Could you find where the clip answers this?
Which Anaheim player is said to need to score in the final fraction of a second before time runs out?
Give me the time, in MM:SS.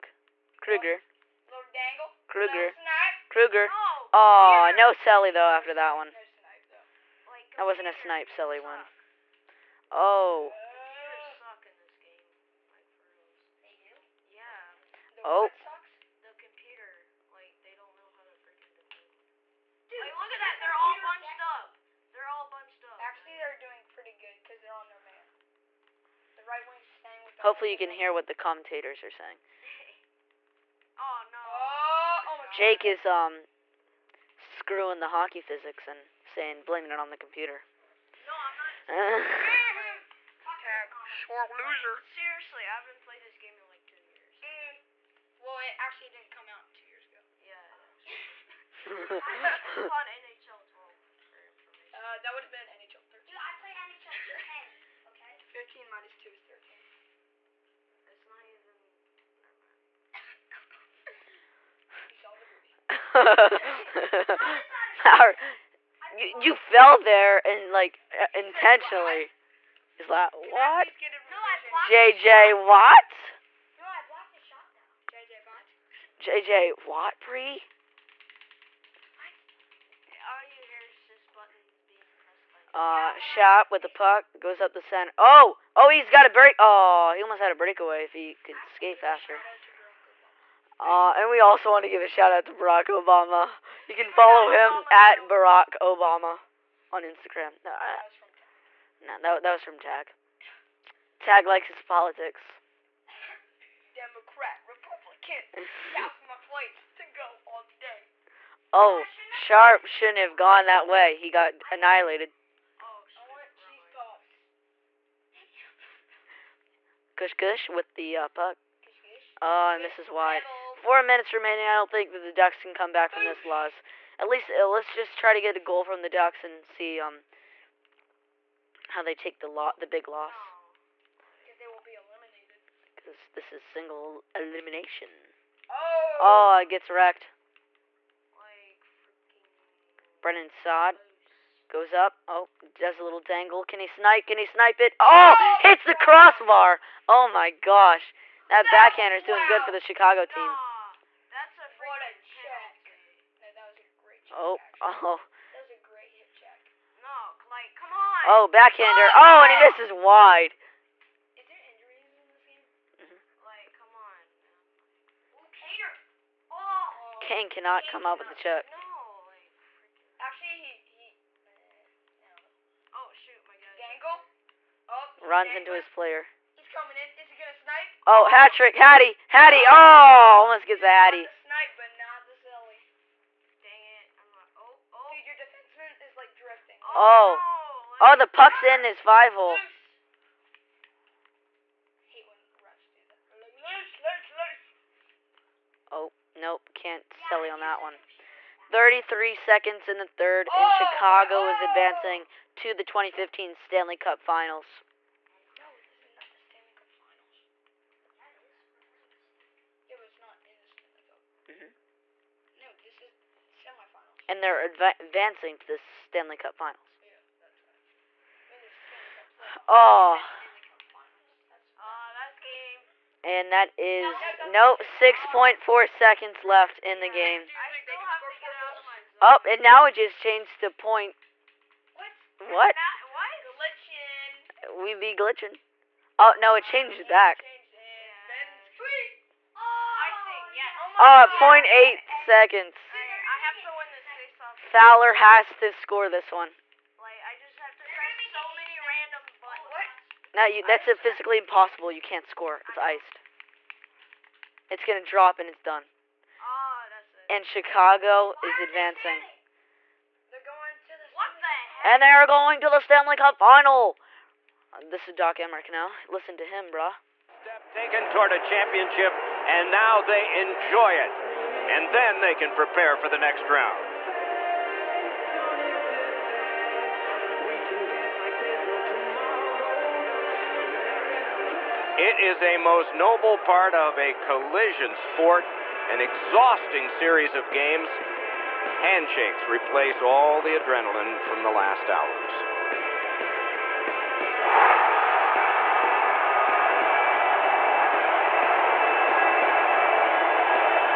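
04:04.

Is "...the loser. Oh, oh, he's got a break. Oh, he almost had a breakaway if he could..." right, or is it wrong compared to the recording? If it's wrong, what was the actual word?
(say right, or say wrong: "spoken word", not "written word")
wrong: "center", not "loser".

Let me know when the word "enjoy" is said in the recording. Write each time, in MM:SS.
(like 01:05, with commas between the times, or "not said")
04:30.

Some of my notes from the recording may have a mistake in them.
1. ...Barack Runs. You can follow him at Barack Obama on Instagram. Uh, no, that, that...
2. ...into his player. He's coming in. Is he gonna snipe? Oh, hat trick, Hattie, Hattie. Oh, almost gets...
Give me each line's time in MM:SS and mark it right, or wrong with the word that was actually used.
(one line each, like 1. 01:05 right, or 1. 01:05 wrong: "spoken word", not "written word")
1. 01:32 wrong: "Obama", not "Runs"
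2. 02:55 right.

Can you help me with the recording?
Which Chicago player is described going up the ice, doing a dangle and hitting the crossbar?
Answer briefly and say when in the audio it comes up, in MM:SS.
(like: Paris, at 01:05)
Brandon Saad, at 02:20.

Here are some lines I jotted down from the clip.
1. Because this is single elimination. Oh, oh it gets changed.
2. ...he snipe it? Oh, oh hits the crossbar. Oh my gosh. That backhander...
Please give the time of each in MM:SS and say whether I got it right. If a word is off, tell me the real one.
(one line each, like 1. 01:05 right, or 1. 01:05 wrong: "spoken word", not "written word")
1. 02:12 wrong: "wrecked", not "changed"
2. 02:24 right.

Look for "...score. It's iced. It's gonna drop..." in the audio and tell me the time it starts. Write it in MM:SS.
04:12.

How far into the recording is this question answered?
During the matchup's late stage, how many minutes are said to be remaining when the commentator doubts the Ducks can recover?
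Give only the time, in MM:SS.
02:00.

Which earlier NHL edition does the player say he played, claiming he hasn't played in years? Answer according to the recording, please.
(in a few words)
NHL 10.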